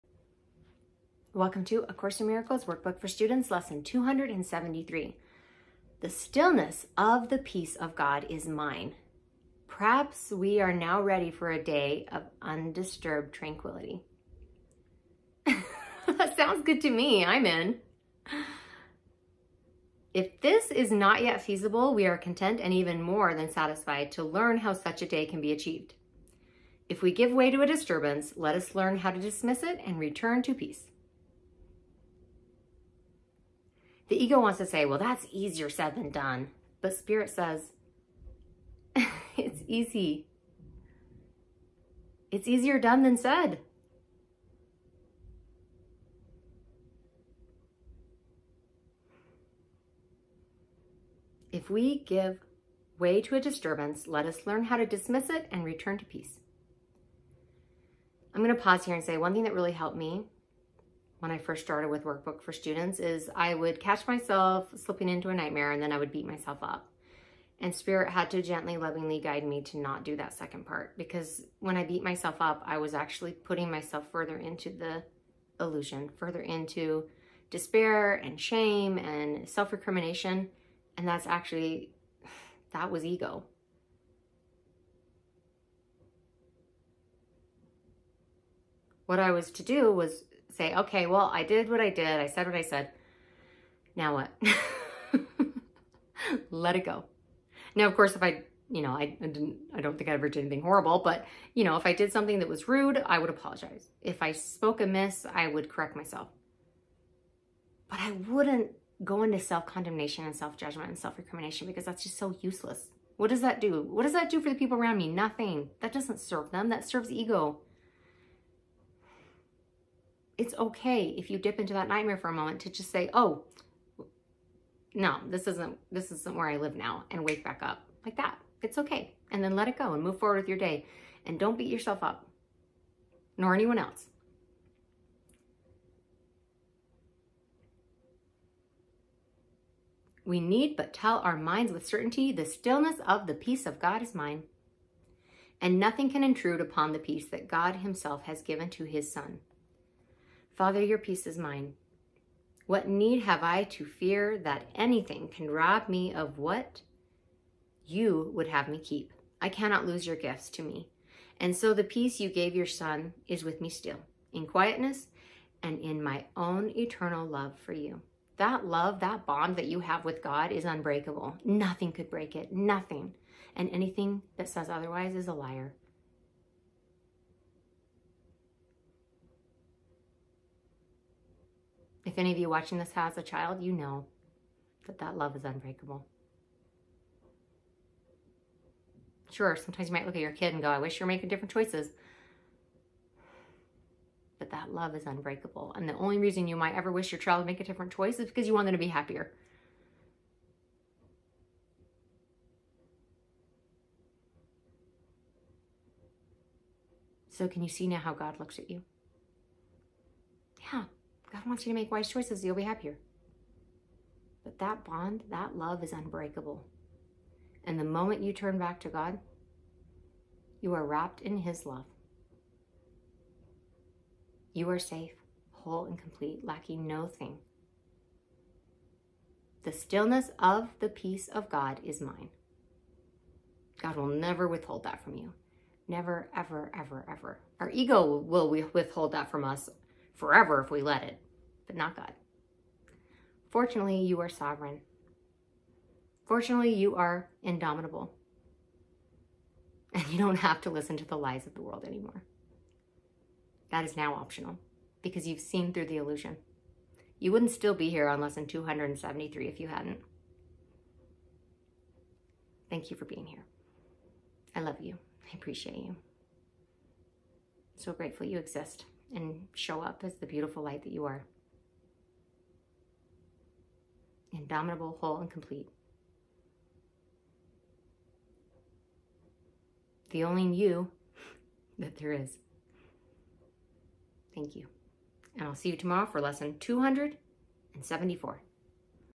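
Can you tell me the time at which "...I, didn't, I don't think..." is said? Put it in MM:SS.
01:39.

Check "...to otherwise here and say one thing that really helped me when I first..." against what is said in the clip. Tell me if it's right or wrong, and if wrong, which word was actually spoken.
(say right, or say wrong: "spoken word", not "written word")
wrong: "pause", not "otherwise".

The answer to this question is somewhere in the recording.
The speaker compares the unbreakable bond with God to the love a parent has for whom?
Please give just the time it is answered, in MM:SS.
03:03.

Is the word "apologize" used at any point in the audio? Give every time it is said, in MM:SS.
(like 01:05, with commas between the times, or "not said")
01:43.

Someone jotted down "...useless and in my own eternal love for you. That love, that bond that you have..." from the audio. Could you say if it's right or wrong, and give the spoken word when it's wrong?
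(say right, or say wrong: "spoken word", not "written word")
wrong: "quietness", not "useless".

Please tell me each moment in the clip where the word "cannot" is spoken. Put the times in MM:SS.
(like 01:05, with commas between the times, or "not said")
02:39.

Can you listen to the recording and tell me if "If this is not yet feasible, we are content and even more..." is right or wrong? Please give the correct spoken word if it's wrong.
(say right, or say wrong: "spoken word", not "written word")
right.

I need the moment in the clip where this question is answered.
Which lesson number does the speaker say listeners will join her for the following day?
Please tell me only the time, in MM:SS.
04:46.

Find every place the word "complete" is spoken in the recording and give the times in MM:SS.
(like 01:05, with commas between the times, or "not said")
03:45, 04:35.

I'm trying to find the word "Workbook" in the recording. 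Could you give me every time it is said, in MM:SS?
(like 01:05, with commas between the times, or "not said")
00:02, 01:02.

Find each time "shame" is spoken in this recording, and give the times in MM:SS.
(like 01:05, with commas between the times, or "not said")
01:18.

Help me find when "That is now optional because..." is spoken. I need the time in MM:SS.
04:13.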